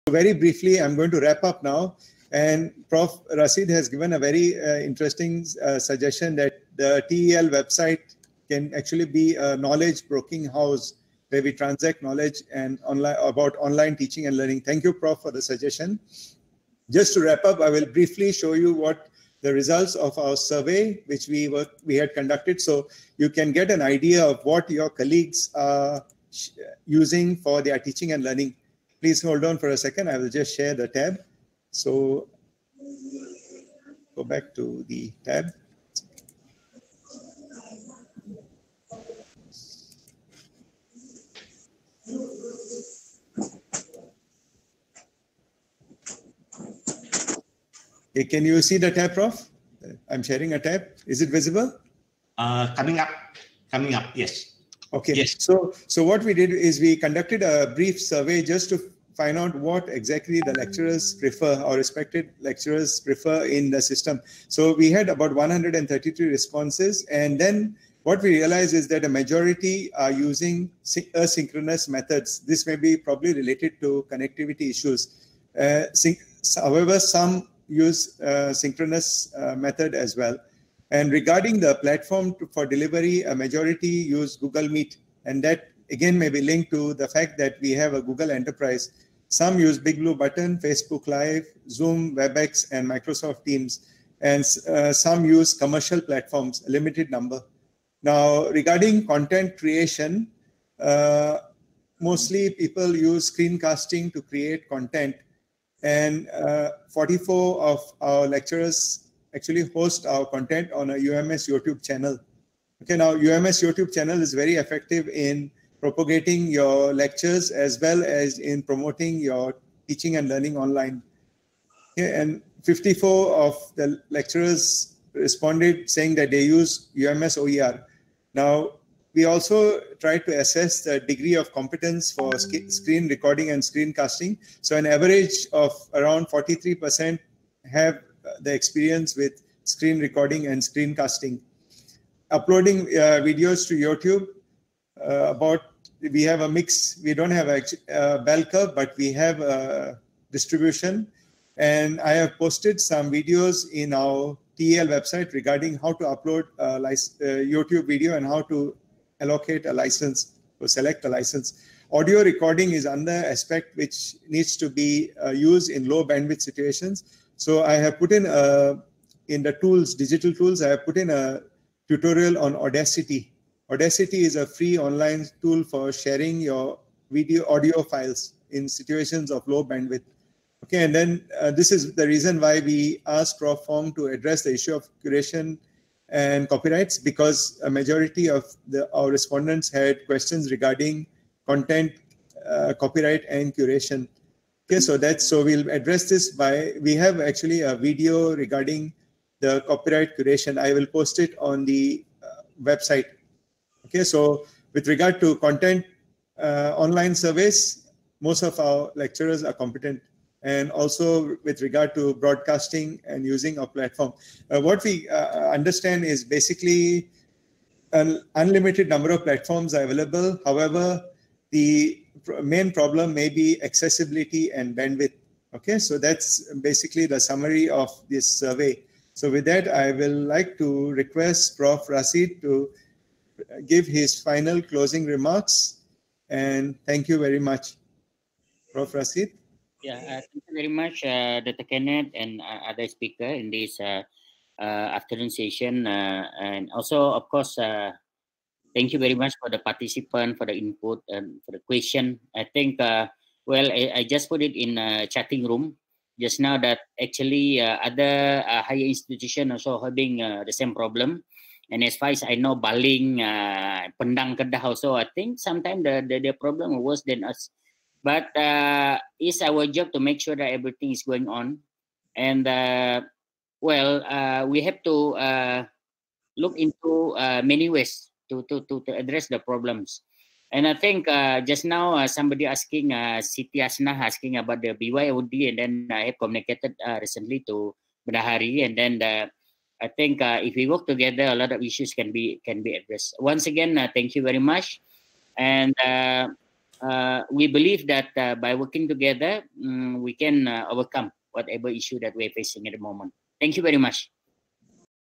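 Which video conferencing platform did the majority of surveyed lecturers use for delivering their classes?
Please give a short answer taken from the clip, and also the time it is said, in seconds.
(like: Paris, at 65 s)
Google Meet, at 84 s.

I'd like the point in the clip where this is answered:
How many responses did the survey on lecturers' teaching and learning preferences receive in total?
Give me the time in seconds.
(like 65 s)
65 s.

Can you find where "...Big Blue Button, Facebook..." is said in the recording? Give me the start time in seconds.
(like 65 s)
89 s.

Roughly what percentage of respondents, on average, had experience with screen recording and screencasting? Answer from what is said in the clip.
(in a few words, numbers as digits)
43%.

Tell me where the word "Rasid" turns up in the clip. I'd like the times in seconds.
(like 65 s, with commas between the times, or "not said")
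3 s, 231 s, 238 s.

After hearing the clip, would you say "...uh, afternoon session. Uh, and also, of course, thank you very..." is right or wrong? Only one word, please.
right.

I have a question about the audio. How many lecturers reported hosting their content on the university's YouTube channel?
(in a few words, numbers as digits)
44.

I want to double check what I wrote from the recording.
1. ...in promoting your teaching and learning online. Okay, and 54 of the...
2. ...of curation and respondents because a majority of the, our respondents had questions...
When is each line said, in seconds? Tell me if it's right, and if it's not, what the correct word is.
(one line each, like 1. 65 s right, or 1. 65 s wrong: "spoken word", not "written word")
1. 118 s right
2. 184 s wrong: "copyrights", not "respondents".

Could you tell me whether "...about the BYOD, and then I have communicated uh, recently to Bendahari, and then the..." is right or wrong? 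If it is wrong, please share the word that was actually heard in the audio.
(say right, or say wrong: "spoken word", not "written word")
right.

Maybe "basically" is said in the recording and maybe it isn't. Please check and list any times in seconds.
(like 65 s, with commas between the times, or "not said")
216 s, 226 s.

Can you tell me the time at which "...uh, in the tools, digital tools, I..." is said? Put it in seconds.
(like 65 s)
168 s.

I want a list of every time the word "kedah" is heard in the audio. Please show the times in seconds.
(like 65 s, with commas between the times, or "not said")
264 s.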